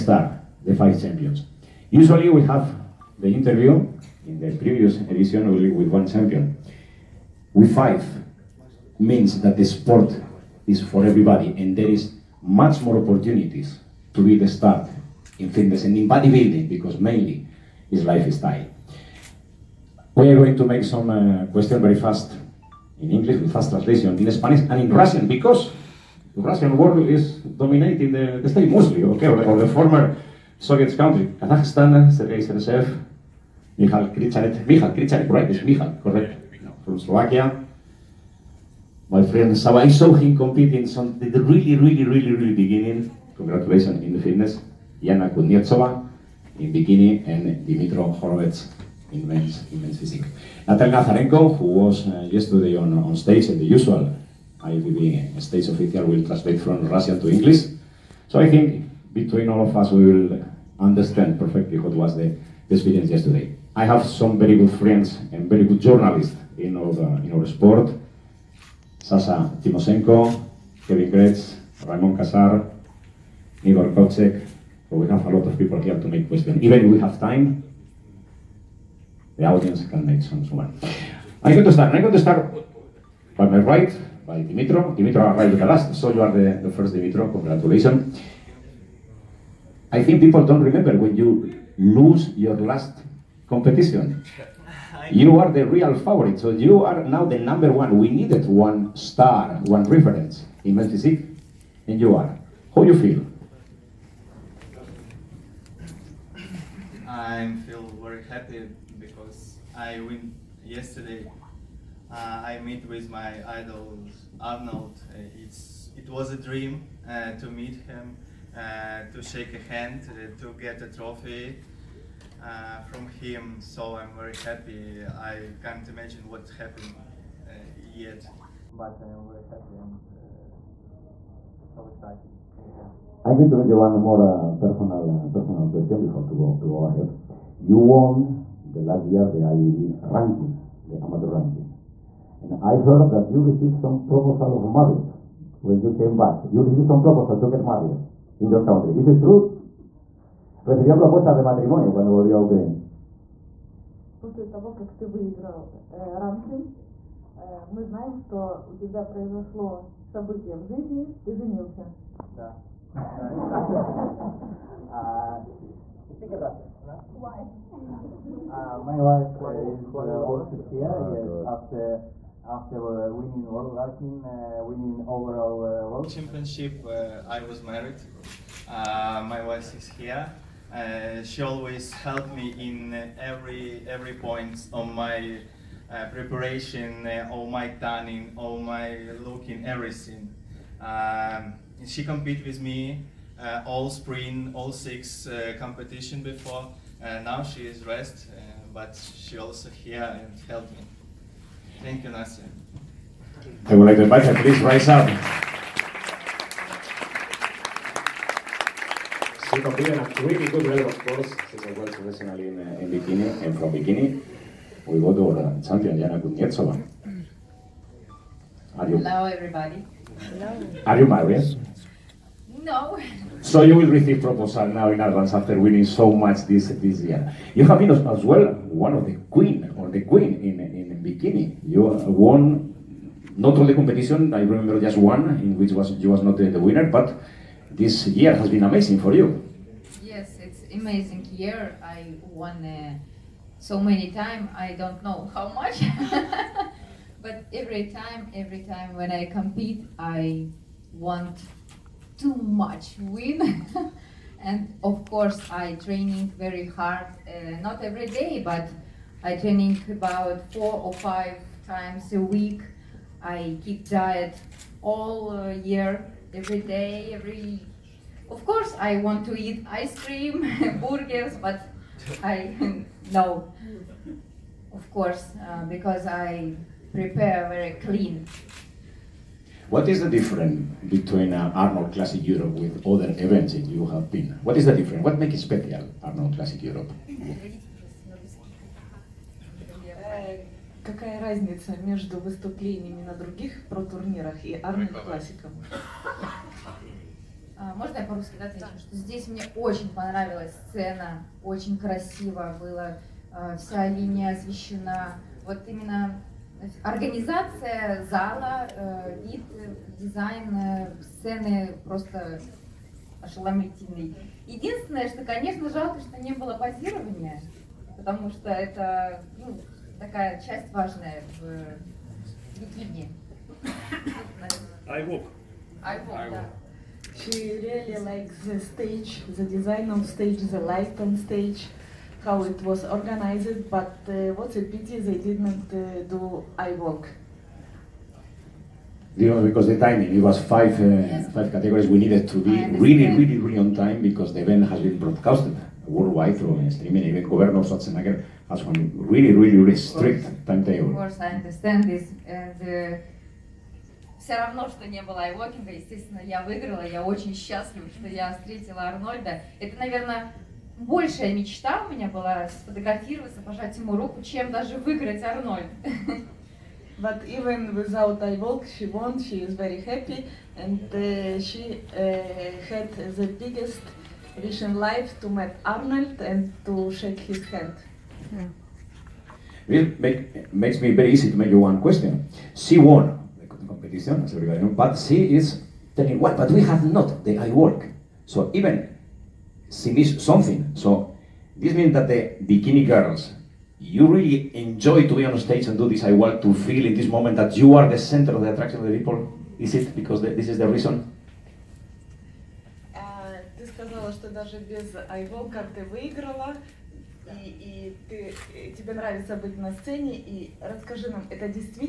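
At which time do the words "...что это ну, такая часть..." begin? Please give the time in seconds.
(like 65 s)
318 s.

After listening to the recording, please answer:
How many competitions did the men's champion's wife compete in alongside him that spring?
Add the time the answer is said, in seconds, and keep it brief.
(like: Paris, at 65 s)
6, at 194 s.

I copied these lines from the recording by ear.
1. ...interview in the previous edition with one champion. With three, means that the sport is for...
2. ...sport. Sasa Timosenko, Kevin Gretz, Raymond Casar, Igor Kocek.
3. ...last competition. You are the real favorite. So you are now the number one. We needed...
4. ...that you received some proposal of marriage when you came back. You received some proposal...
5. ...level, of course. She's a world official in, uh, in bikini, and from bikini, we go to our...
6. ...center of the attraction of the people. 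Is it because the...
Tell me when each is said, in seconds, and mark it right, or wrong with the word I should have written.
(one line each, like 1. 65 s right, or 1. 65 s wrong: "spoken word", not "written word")
1. 3 s wrong: "five", not "three"
2. 67 s right
3. 92 s right
4. 143 s right
5. 210 s wrong: "professional", not "official"
6. 397 s right.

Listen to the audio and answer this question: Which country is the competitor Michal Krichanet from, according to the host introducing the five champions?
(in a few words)
Slovakia.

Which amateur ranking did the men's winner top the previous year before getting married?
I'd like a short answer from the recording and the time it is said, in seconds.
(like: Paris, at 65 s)
IEB ranking, at 139 s.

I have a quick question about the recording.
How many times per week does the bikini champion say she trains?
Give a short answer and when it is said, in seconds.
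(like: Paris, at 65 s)
4 or 5, at 260 s.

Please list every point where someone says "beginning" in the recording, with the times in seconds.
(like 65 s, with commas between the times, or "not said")
42 s.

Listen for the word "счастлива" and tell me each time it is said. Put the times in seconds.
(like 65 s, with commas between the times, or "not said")
357 s.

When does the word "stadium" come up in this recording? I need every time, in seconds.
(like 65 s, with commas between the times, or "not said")
not said.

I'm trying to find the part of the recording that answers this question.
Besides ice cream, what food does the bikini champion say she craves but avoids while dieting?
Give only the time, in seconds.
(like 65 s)
270 s.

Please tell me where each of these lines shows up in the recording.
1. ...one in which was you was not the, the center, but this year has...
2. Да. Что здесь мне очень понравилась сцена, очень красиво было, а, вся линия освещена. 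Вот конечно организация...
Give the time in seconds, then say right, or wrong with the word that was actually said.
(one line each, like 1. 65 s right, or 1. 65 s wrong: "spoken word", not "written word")
1. 234 s wrong: "winner", not "center"
2. 298 s wrong: "именно", not "конечно".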